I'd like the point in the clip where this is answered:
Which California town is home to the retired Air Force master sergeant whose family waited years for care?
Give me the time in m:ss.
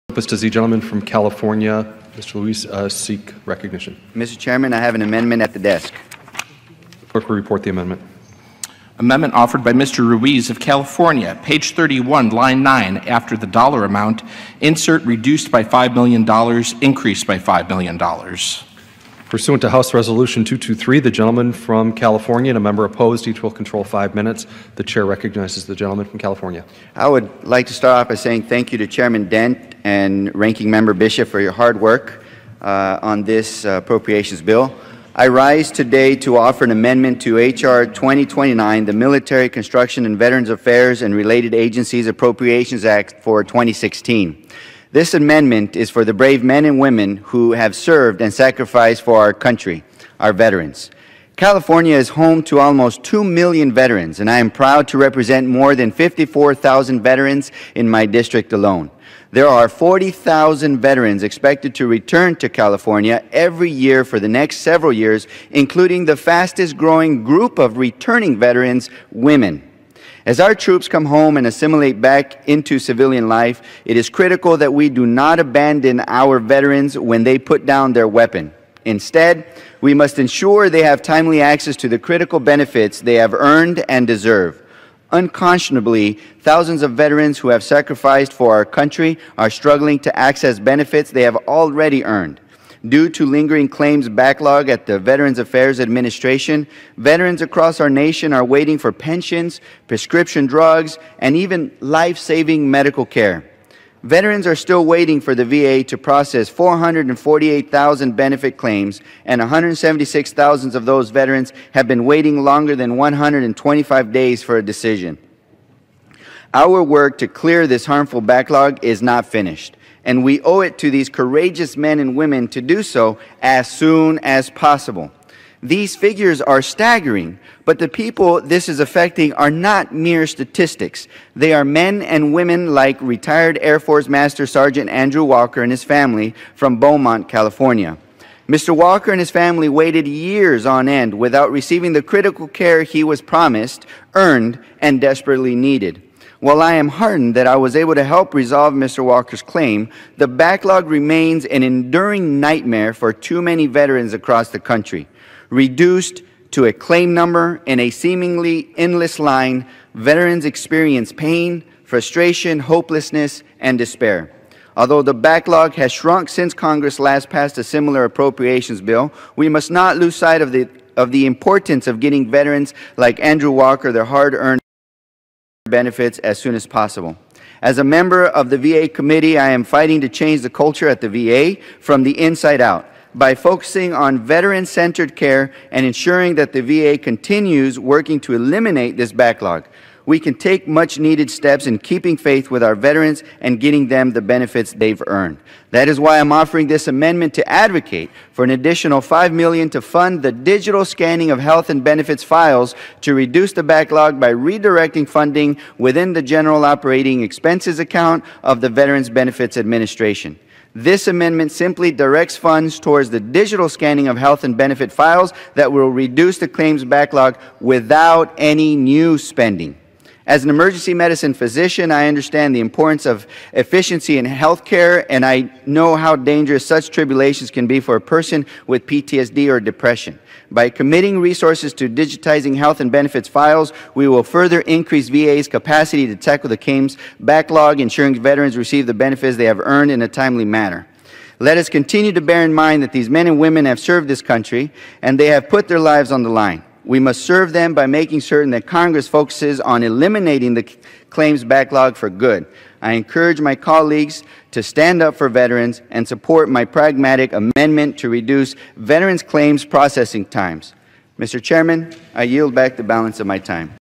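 2:16.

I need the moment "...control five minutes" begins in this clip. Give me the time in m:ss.
0:23.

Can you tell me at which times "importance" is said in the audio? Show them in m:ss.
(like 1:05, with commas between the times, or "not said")
2:51, 3:42.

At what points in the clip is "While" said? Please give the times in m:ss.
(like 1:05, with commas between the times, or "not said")
2:26.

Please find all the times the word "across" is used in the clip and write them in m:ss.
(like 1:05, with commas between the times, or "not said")
1:37, 2:34.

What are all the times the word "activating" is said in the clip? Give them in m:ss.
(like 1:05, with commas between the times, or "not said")
not said.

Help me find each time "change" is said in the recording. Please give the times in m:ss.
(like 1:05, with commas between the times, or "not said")
3:00.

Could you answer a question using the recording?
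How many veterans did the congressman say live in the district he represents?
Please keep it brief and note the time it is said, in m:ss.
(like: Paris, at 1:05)
54,000, at 0:55.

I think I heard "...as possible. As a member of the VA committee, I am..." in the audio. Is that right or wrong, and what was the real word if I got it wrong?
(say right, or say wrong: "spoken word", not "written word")
right.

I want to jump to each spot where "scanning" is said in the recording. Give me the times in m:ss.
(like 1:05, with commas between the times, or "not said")
3:20, 3:33.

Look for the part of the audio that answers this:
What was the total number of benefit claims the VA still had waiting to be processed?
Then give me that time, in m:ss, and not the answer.
1:46.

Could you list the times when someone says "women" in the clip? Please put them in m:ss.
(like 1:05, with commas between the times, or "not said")
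0:46, 1:09, 2:02, 2:12, 4:03.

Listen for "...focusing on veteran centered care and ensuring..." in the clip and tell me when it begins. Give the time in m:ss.
3:03.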